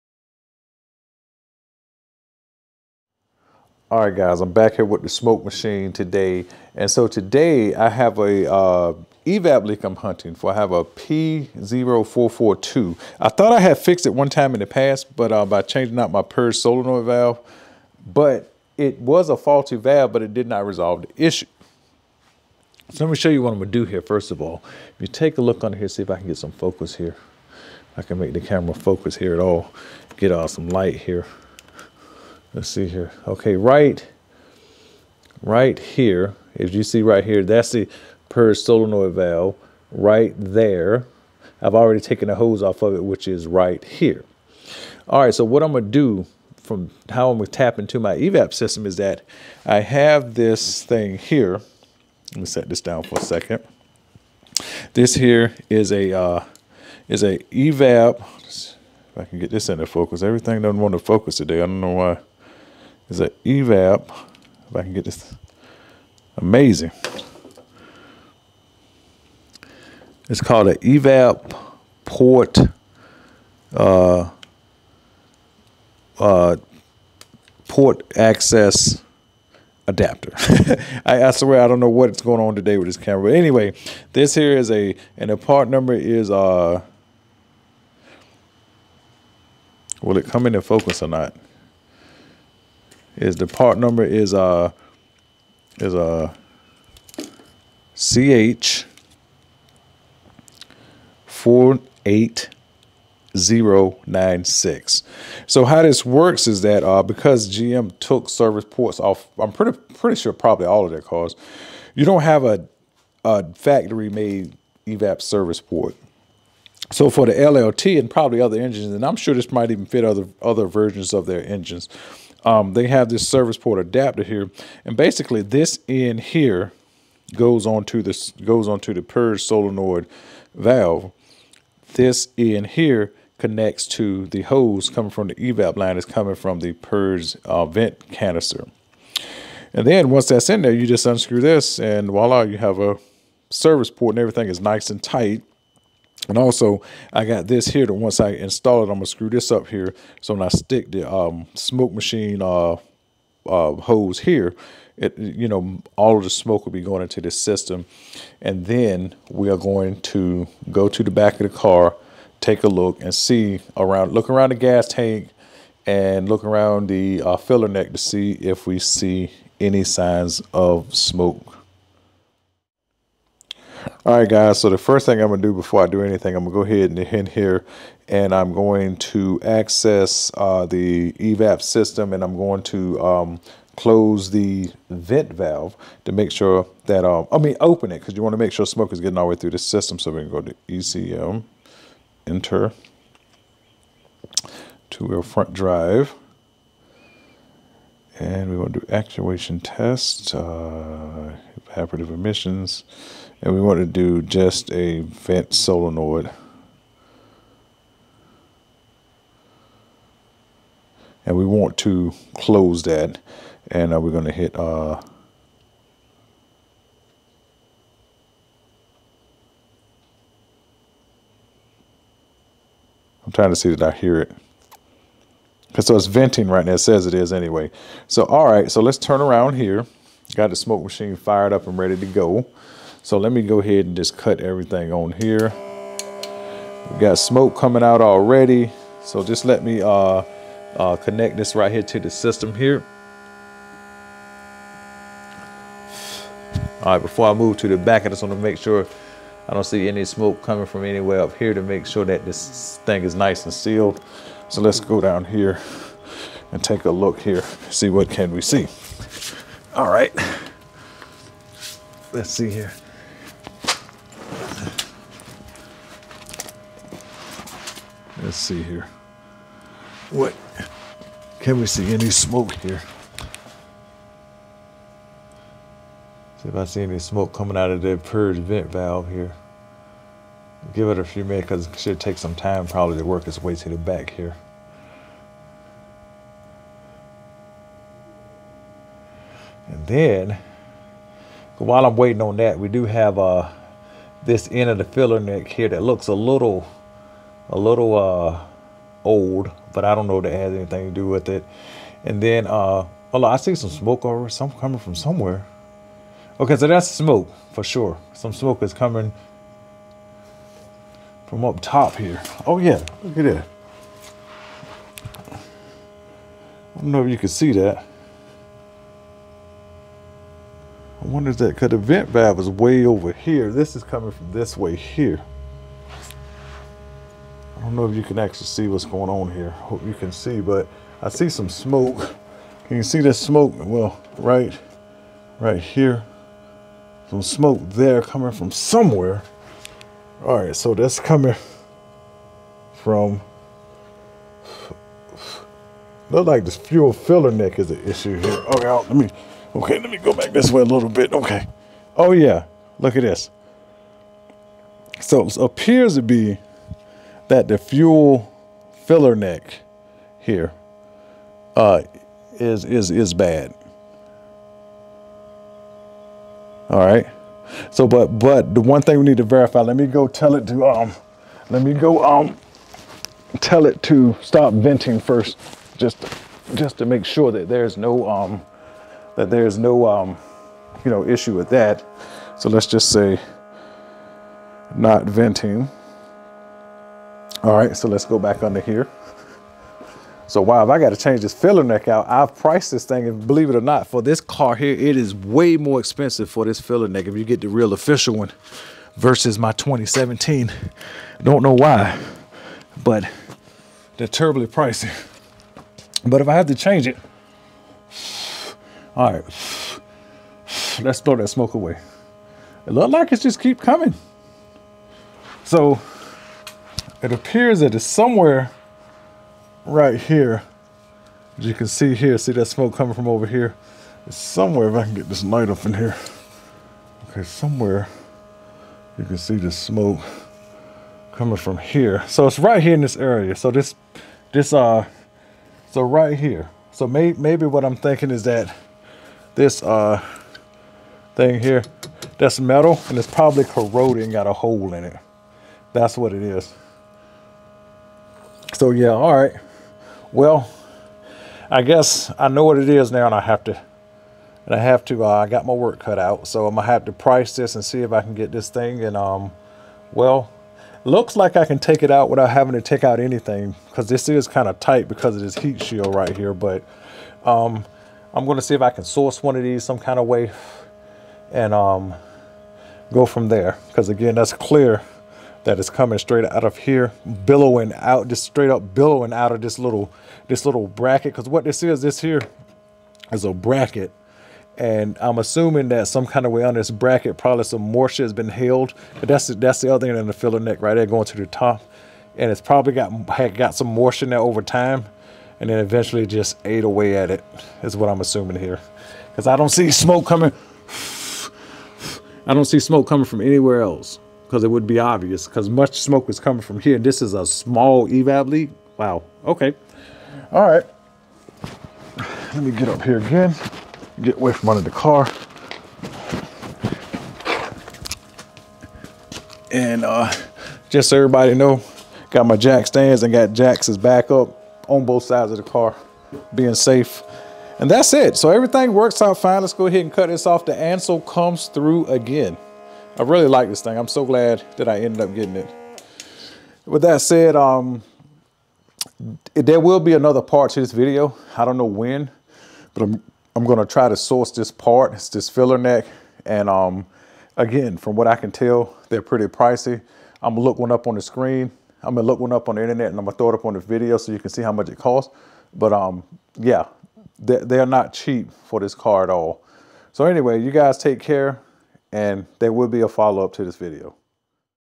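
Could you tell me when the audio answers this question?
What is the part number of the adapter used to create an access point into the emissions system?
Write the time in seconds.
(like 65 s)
97 s.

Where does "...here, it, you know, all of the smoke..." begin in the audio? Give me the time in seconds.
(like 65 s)
154 s.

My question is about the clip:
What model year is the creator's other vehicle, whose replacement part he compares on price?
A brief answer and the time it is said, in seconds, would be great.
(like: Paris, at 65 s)
2017, at 399 s.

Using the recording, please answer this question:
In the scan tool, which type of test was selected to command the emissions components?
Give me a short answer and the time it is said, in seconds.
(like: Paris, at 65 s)
actuation test, at 198 s.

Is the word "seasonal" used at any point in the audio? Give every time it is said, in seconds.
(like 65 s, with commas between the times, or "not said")
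not said.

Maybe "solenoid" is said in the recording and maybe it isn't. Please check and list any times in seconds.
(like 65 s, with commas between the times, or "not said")
16 s, 38 s, 129 s, 205 s.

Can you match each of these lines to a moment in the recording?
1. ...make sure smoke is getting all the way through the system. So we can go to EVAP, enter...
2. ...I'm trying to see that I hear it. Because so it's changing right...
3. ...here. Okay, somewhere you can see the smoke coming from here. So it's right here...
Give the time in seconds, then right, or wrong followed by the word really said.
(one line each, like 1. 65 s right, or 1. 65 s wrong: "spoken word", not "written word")
1. 188 s wrong: "ECM", not "EVAP"
2. 223 s wrong: "venting", not "changing"
3. 425 s right.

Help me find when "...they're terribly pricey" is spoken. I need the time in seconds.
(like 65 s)
403 s.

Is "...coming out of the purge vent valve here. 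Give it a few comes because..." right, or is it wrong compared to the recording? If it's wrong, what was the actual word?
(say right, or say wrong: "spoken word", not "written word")
wrong: "minutes", not "comes".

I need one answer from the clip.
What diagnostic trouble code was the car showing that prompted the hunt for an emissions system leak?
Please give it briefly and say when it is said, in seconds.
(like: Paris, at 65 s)
P0442, at 10 s.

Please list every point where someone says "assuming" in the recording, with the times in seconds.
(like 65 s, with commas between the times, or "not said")
485 s, 497 s.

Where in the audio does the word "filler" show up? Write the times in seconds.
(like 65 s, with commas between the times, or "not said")
167 s, 294 s, 346 s, 358 s, 391 s, 396 s, 490 s, 545 s.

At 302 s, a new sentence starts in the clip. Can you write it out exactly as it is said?
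And then, uh, oh, I see some smoke over some coming from somewhere.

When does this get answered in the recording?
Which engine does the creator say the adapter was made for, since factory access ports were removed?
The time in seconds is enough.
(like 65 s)
117 s.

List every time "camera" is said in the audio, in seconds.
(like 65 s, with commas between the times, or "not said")
28 s, 82 s.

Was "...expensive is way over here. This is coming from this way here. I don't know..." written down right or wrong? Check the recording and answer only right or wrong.
wrong.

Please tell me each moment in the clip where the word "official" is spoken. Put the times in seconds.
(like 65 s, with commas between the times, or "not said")
397 s.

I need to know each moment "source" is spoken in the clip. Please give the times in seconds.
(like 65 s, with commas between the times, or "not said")
468 s, 543 s.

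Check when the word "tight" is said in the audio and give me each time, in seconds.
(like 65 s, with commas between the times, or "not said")
145 s, 464 s.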